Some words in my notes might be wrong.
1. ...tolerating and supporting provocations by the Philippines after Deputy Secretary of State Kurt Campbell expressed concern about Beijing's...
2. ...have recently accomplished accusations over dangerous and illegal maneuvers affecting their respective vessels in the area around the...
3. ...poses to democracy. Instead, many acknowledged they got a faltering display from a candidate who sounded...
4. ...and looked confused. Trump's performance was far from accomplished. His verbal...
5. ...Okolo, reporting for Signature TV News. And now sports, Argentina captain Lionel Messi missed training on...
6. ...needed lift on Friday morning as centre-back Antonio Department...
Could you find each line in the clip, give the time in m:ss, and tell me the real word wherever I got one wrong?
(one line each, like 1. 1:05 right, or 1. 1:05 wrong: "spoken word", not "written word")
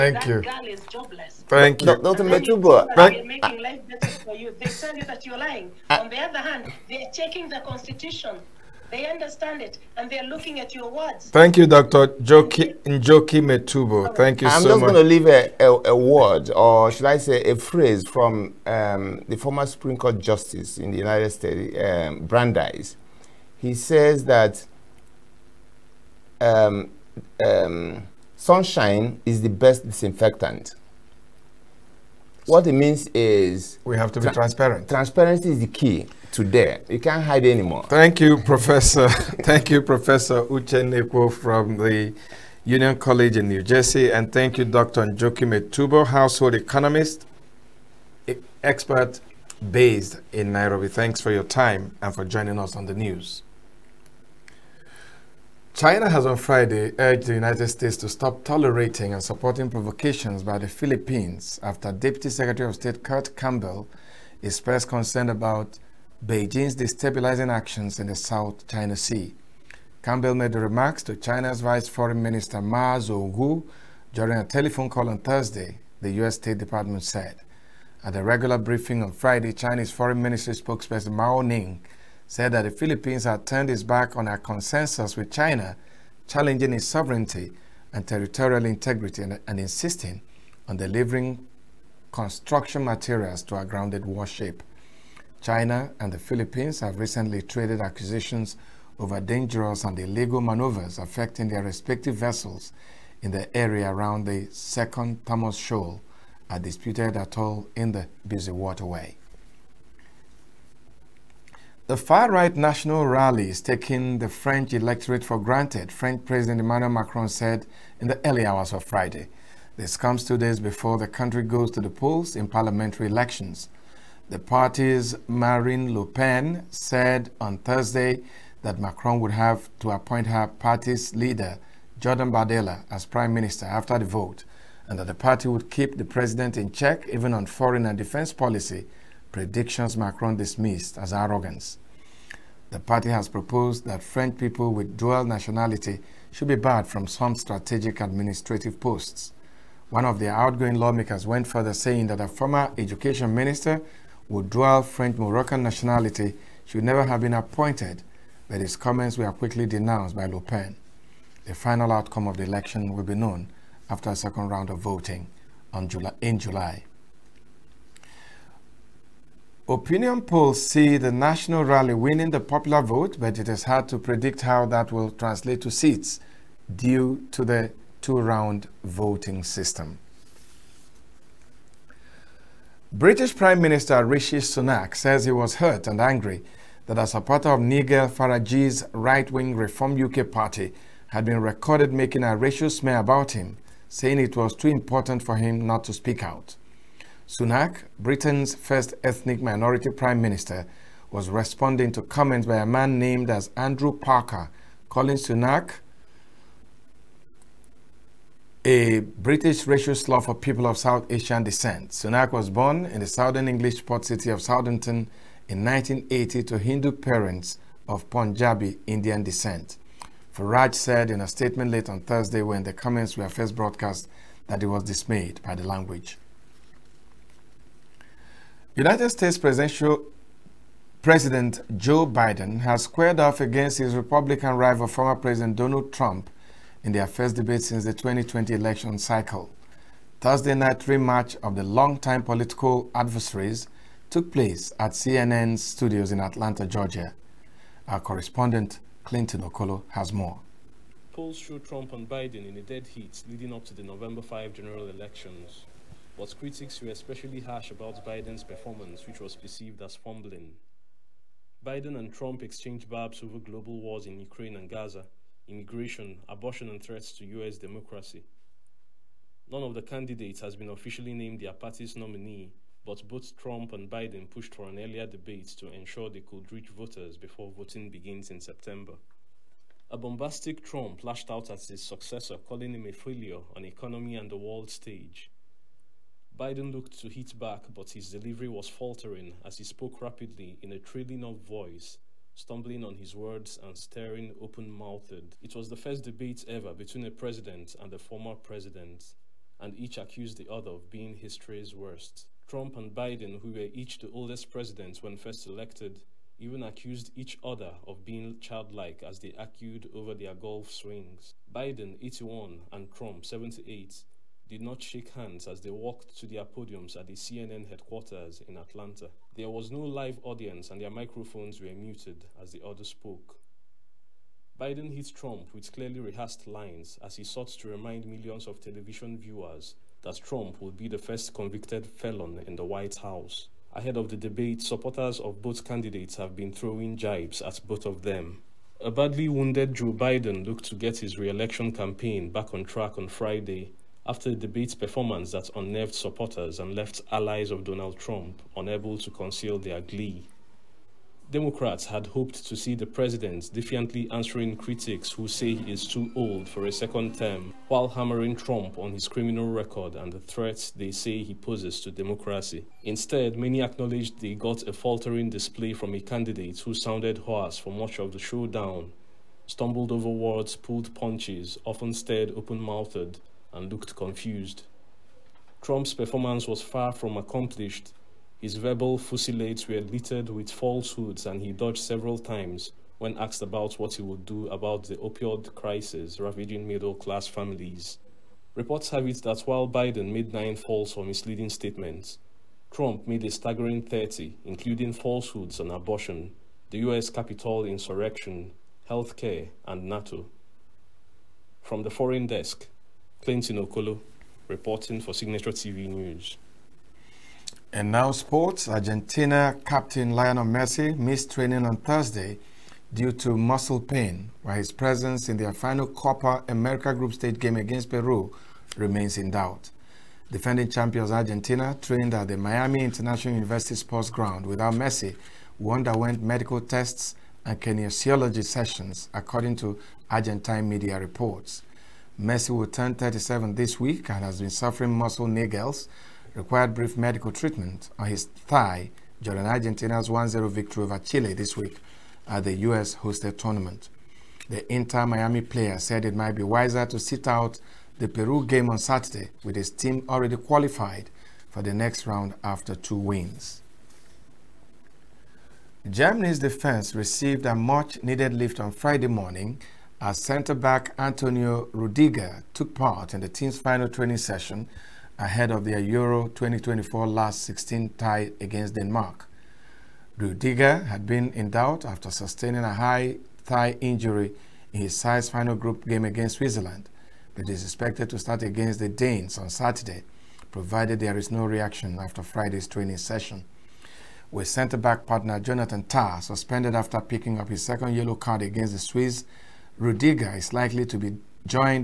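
1. 0:58 right
2. 1:36 wrong: "traded", not "accomplished"
3. 6:01 right
4. 6:13 right
5. 6:43 right
6. 7:38 wrong: "Rudiger", not "Department".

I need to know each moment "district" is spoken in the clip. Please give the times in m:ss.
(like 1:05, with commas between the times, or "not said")
not said.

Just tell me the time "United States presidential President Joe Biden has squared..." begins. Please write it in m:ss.
3:48.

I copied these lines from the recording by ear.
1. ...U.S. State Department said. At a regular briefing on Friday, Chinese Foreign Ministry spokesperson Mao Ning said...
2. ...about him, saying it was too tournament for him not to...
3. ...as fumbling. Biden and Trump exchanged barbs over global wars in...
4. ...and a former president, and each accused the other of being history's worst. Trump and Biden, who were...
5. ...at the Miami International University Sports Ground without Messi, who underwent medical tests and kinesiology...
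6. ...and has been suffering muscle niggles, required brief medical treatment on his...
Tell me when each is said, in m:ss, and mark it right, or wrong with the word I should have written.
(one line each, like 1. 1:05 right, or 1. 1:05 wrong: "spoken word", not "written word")
1. 1:16 right
2. 3:12 wrong: "important", not "tournament"
3. 4:19 right
4. 4:57 right
5. 7:02 right
6. 7:14 right.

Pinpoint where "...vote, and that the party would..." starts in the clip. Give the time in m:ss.
2:14.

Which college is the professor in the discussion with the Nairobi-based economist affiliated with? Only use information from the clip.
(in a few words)
Union College.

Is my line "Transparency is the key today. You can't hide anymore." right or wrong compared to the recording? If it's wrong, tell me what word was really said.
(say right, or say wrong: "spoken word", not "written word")
right.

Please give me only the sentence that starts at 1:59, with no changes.
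This comes two days before the country goes to the polls in parliamentary elections.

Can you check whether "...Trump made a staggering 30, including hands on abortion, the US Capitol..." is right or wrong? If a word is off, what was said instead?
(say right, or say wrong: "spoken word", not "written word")
wrong: "falsehoods", not "hands".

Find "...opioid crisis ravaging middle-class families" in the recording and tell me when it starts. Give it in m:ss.
6:24.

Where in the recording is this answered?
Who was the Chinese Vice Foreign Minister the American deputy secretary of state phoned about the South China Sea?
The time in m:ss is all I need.
1:12.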